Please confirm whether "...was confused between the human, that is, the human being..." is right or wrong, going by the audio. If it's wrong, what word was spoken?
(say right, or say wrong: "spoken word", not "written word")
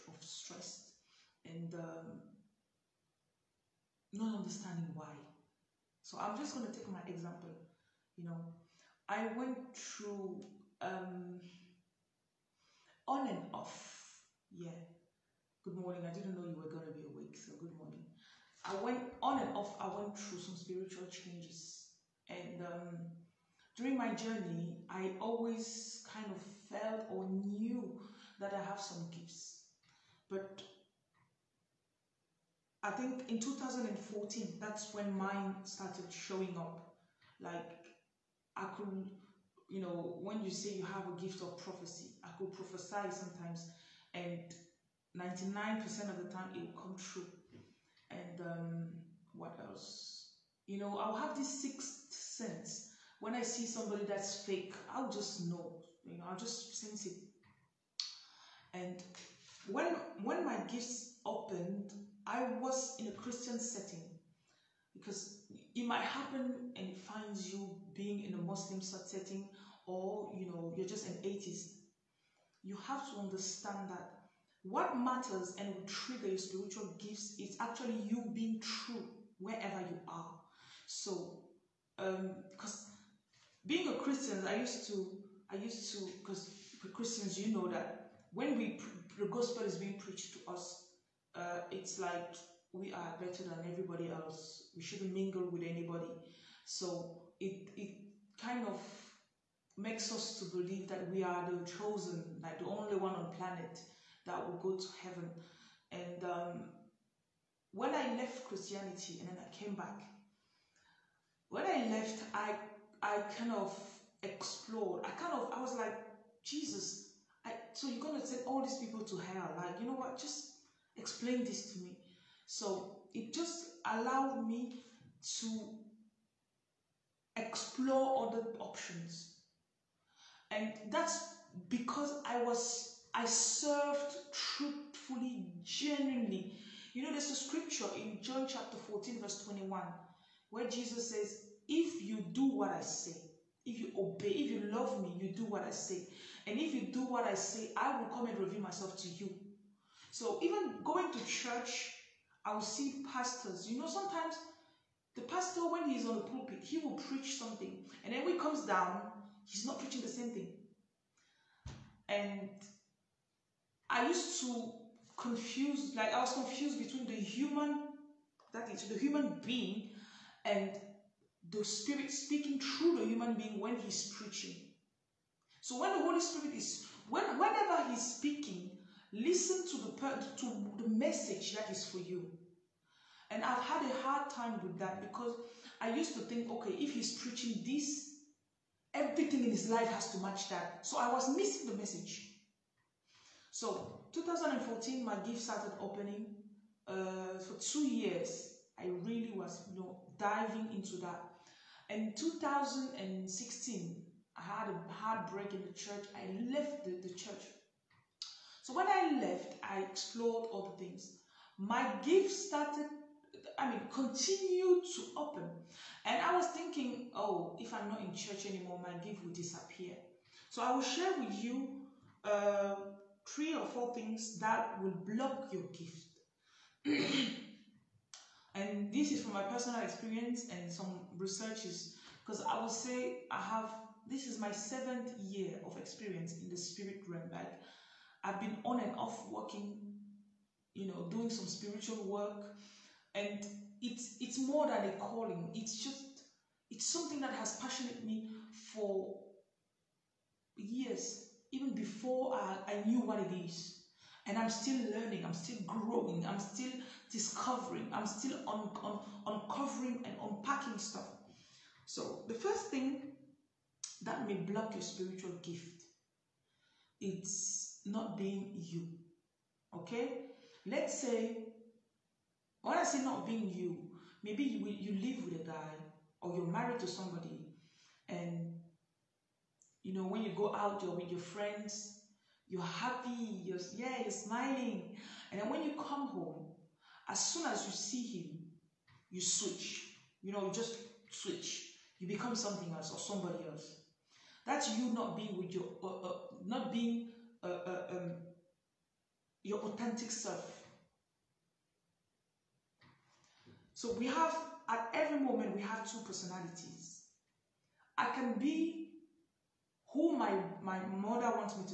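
right.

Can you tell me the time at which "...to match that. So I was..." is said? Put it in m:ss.
3:10.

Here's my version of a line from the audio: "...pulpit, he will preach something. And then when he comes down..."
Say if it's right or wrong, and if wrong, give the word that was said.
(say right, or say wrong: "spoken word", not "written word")
right.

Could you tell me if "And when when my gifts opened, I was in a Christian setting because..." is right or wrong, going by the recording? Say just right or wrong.
right.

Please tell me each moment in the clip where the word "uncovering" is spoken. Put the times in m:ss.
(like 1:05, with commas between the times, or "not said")
4:19.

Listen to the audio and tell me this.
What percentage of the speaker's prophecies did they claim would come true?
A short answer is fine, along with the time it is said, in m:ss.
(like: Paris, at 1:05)
99%, at 0:45.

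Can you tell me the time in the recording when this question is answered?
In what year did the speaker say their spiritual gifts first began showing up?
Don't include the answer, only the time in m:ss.
0:33.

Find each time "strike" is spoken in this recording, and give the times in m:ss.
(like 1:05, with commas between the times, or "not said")
not said.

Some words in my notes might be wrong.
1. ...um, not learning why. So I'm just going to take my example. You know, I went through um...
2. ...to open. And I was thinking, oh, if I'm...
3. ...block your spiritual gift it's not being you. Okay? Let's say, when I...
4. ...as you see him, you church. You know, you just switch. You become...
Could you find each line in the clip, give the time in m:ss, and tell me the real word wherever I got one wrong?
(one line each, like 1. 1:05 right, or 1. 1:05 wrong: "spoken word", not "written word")
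1. 0:01 wrong: "understanding", not "learning"
2. 3:34 right
3. 4:24 right
4. 4:47 wrong: "switch", not "church".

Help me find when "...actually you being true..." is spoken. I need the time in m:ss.
1:17.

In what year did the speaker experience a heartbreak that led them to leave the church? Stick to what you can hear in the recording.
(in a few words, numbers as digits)
2016.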